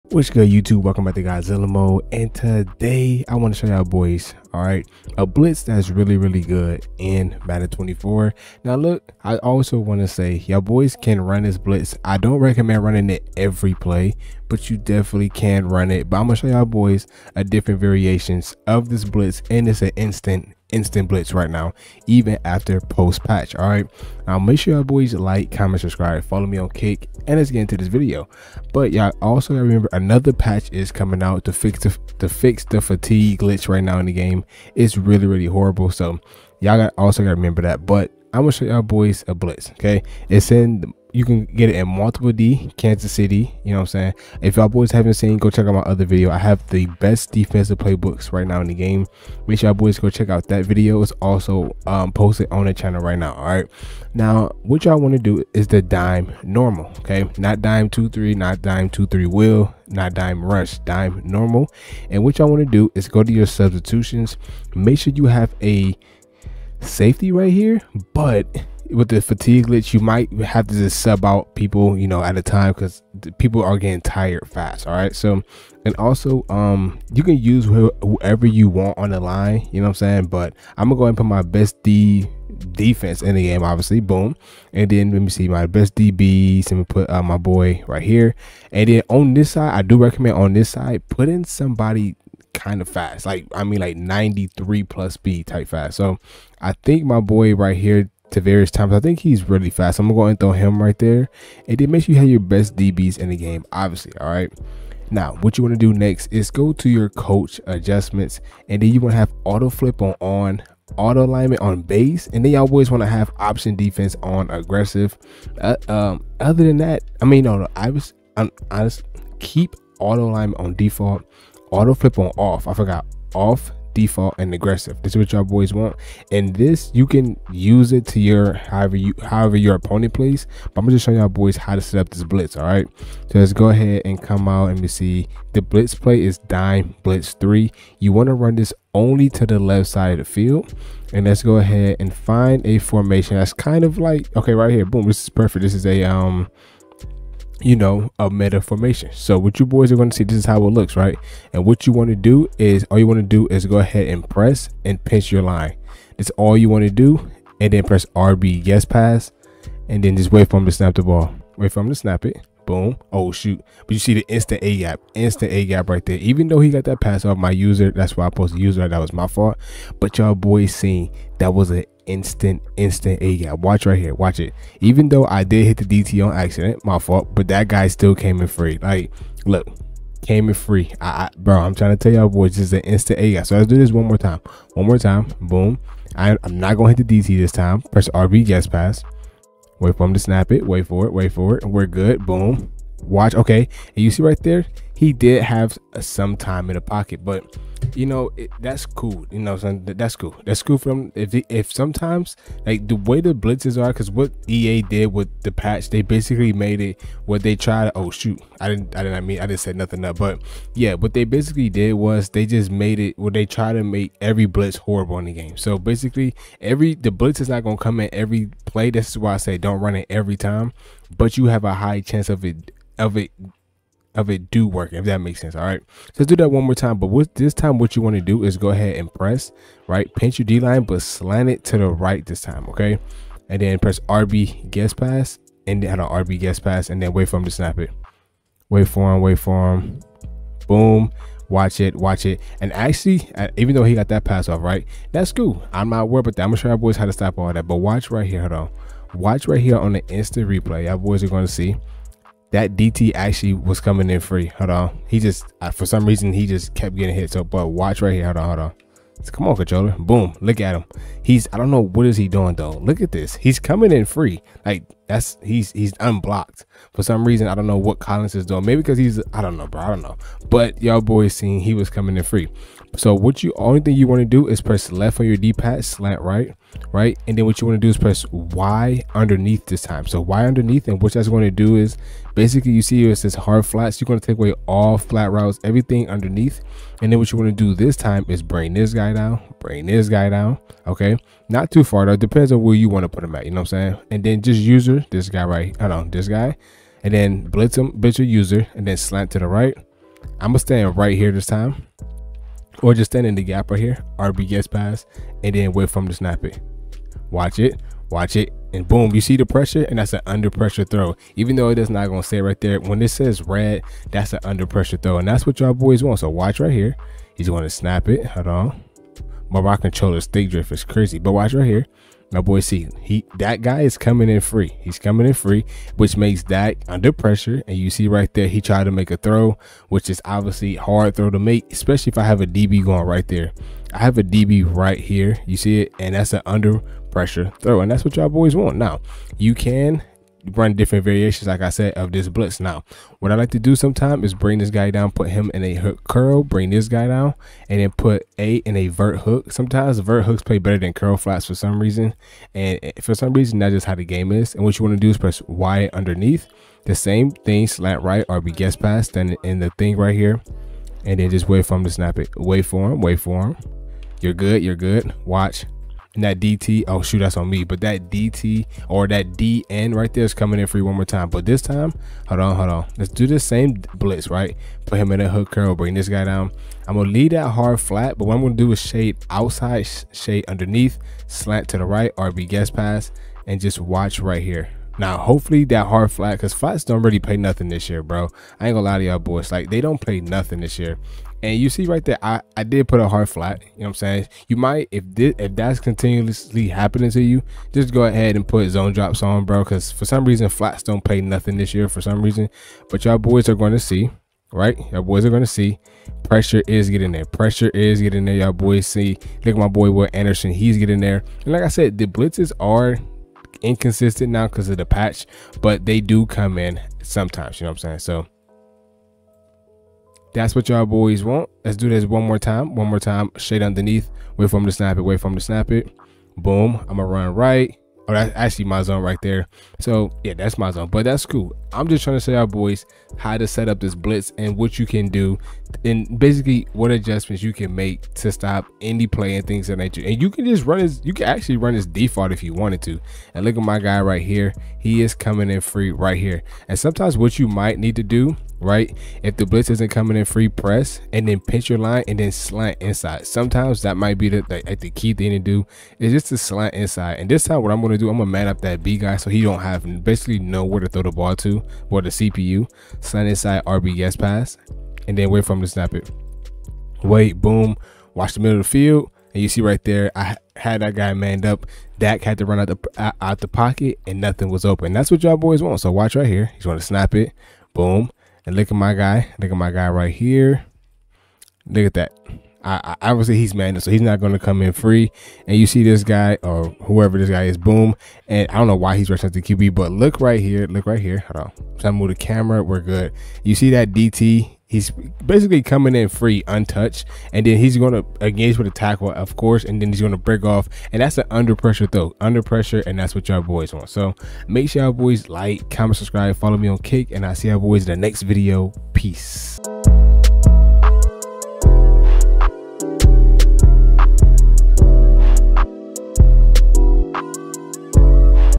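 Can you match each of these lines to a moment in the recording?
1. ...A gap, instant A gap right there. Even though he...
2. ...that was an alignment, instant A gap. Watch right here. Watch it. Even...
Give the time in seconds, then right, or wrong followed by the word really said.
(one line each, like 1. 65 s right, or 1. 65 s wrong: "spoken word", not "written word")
1. 164 s right
2. 171 s wrong: "instant", not "alignment".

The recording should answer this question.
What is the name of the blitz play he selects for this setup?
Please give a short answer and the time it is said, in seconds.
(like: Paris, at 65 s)
Dime blitz three, at 136 s.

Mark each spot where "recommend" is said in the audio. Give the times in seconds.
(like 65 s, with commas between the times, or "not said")
12 s, 89 s.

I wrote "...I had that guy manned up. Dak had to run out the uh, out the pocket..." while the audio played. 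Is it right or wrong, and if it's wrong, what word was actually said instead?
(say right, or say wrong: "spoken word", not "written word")
right.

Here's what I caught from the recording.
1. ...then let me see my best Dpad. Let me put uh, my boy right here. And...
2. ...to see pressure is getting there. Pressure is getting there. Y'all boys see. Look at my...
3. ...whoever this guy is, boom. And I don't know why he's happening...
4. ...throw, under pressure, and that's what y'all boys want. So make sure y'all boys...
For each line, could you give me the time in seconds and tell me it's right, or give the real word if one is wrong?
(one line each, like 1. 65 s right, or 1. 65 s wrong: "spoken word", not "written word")
1. 84 s wrong: "DBs", not "Dpad"
2. 405 s right
3. 486 s wrong: "rushing", not "happening"
4. 501 s right.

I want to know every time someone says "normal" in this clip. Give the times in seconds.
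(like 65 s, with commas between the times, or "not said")
56 s, 61 s.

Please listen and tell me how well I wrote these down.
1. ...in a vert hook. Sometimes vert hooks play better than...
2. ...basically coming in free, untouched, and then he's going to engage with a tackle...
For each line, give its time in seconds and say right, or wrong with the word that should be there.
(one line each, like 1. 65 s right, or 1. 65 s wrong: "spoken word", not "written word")
1. 348 s right
2. 495 s right.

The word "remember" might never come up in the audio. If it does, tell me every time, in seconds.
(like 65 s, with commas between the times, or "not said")
29 s, 37 s.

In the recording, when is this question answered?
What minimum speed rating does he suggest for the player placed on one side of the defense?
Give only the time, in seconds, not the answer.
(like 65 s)
93 s.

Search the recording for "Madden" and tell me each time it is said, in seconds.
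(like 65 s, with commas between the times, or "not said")
7 s.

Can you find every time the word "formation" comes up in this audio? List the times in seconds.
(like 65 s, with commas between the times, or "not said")
142 s, 148 s.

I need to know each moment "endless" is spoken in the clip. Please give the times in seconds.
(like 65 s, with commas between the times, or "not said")
not said.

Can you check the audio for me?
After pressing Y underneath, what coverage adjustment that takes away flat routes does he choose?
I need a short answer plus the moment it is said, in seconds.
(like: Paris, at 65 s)
Hard flats, at 283 s.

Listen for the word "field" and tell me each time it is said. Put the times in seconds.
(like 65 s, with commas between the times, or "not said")
140 s, 468 s.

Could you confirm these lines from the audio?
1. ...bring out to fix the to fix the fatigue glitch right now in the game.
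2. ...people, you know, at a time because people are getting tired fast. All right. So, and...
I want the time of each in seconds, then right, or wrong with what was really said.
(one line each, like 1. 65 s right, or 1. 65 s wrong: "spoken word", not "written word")
1. 30 s wrong: "coming", not "bring"
2. 71 s right.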